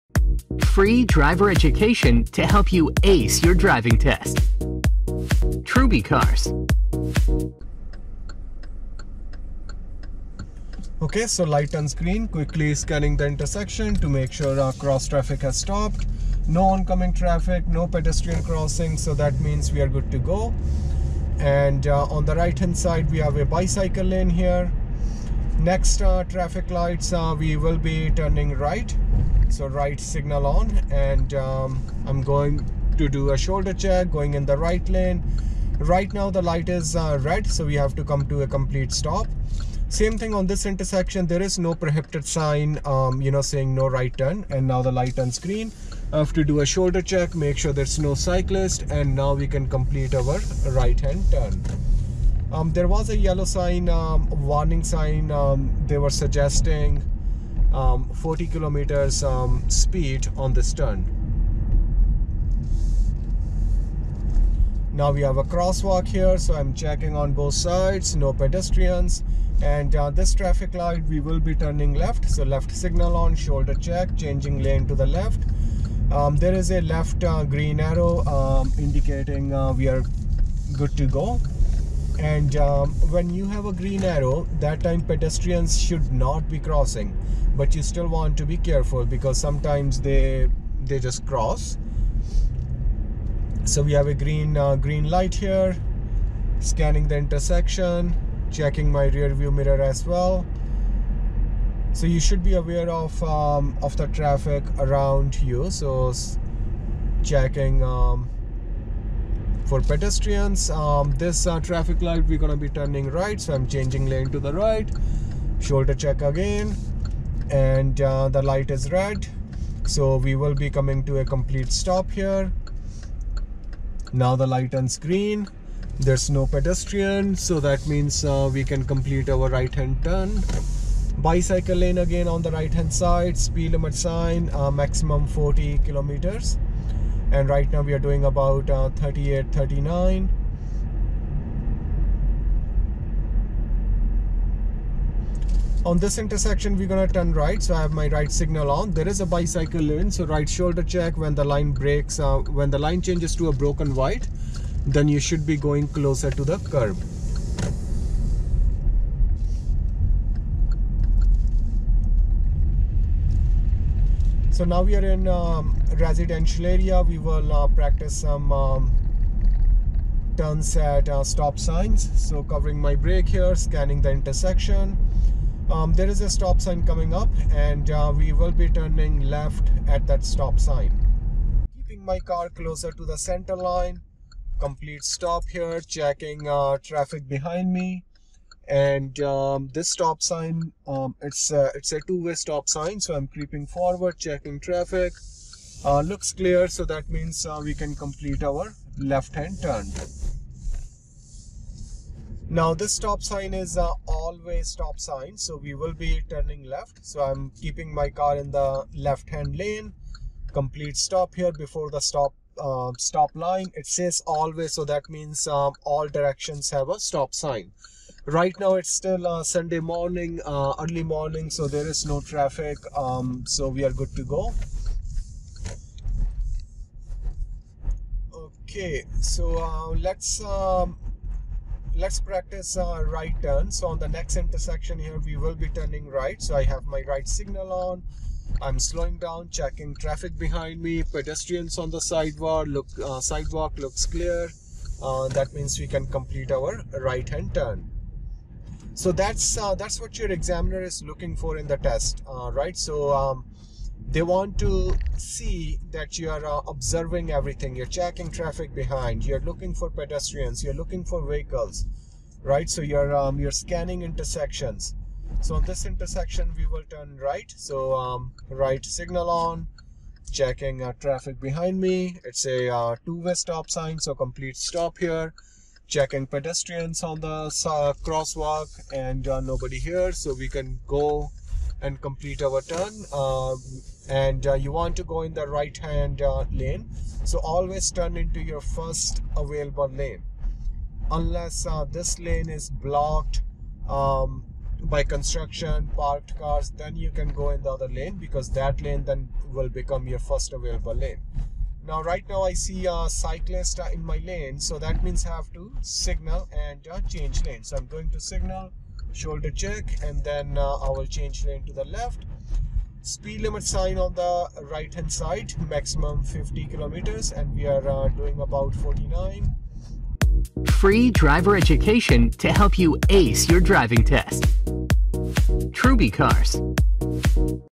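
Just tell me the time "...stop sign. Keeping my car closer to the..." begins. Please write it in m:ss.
3:00.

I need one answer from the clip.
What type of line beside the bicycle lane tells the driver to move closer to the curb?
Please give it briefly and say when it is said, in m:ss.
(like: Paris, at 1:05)
broken white, at 2:33.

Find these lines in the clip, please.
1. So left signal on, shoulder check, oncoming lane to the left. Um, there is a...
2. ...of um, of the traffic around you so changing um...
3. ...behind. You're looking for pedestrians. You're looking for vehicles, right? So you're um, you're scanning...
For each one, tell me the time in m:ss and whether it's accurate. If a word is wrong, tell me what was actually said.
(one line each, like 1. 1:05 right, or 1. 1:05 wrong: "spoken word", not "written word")
1. 1:12 wrong: "changing", not "oncoming"
2. 1:42 wrong: "checking", not "changing"
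3. 4:18 right.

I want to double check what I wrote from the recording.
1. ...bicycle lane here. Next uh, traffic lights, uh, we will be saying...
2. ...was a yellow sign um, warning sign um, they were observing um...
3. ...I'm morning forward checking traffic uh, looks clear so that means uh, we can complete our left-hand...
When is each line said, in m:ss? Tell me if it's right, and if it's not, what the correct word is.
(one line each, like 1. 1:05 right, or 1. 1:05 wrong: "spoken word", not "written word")
1. 0:23 wrong: "turning", not "saying"
2. 0:52 wrong: "suggesting", not "observing"
3. 3:13 wrong: "creeping", not "morning".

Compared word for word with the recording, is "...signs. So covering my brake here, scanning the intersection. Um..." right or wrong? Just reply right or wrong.
right.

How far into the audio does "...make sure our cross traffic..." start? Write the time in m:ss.
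0:14.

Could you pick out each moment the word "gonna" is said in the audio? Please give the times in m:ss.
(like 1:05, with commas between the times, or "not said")
1:52, 2:26.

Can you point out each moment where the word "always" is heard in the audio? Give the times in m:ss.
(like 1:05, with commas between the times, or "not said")
3:24, 3:34, 4:47.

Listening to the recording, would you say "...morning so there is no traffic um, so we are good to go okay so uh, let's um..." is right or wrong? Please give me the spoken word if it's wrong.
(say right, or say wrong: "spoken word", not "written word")
right.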